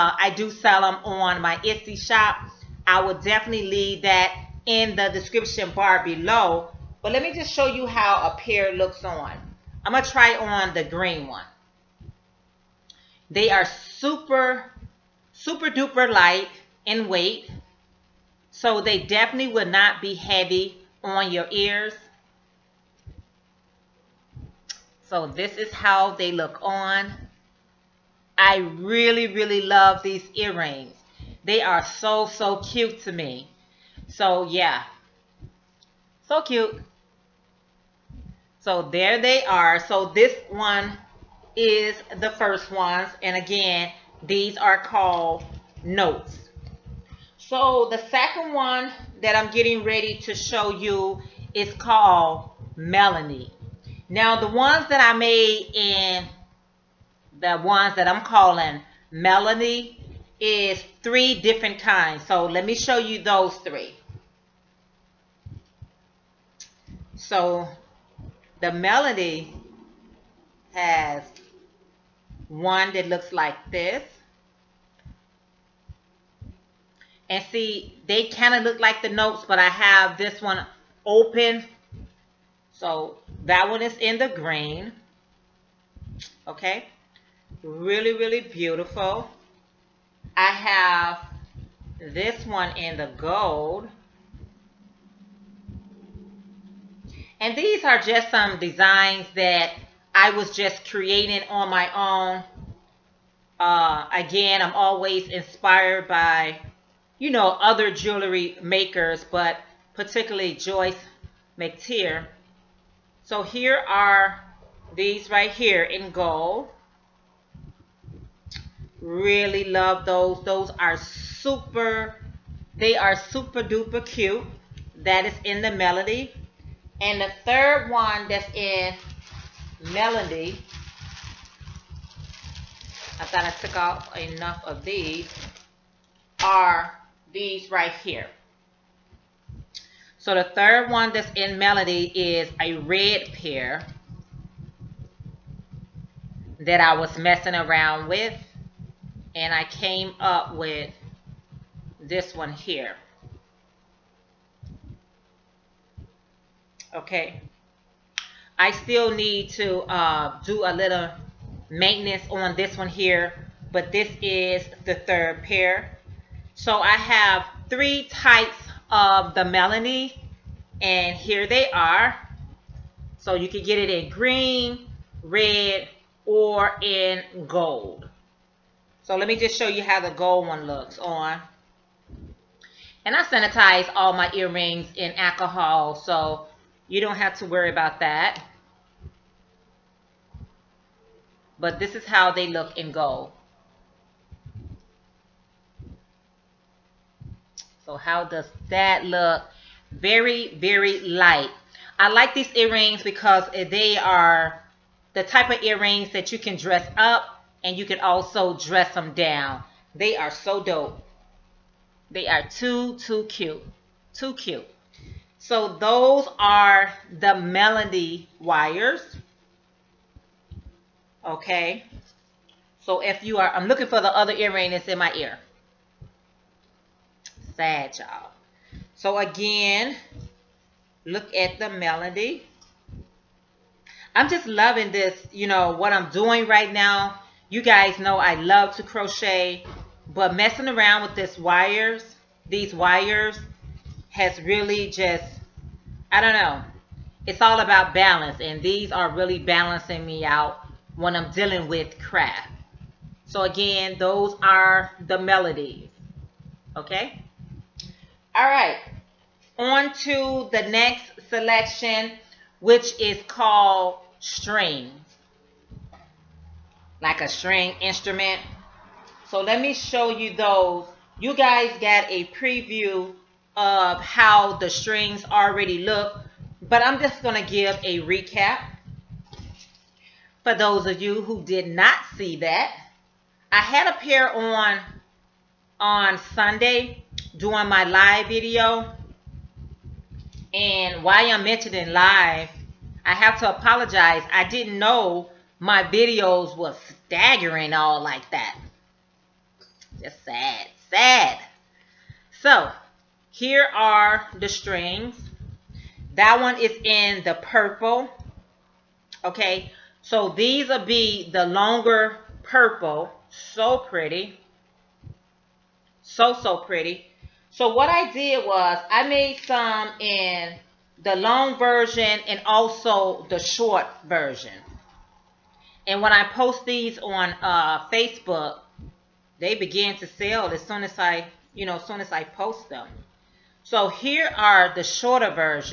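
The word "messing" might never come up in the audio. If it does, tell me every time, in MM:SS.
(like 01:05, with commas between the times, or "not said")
02:27, 04:00.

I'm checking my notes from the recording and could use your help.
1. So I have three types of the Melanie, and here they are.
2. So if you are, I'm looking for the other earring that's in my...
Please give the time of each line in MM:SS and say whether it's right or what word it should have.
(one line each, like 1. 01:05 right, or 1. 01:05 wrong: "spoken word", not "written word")
1. 02:46 right
2. 03:42 right.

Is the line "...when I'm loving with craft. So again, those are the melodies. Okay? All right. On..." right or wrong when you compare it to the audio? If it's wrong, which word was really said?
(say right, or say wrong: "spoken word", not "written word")
wrong: "dealing", not "loving".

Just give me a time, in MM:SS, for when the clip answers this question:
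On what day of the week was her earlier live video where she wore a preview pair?
04:46.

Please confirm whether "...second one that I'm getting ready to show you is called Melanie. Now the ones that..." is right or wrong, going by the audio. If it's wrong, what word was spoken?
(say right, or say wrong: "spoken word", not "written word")
right.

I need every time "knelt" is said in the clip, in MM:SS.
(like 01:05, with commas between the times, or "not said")
not said.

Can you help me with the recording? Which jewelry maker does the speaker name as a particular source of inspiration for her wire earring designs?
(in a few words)
Joyce McTeer.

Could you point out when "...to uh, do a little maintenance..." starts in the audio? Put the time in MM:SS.
02:39.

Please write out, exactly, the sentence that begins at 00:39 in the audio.
So this one is the first ones.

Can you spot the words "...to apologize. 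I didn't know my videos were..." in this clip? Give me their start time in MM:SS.
04:53.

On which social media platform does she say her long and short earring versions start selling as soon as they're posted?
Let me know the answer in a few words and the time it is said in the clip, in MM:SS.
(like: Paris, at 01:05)
Facebook, at 05:27.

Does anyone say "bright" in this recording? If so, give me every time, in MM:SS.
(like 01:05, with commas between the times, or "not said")
not said.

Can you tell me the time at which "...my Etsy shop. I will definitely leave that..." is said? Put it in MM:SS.
00:01.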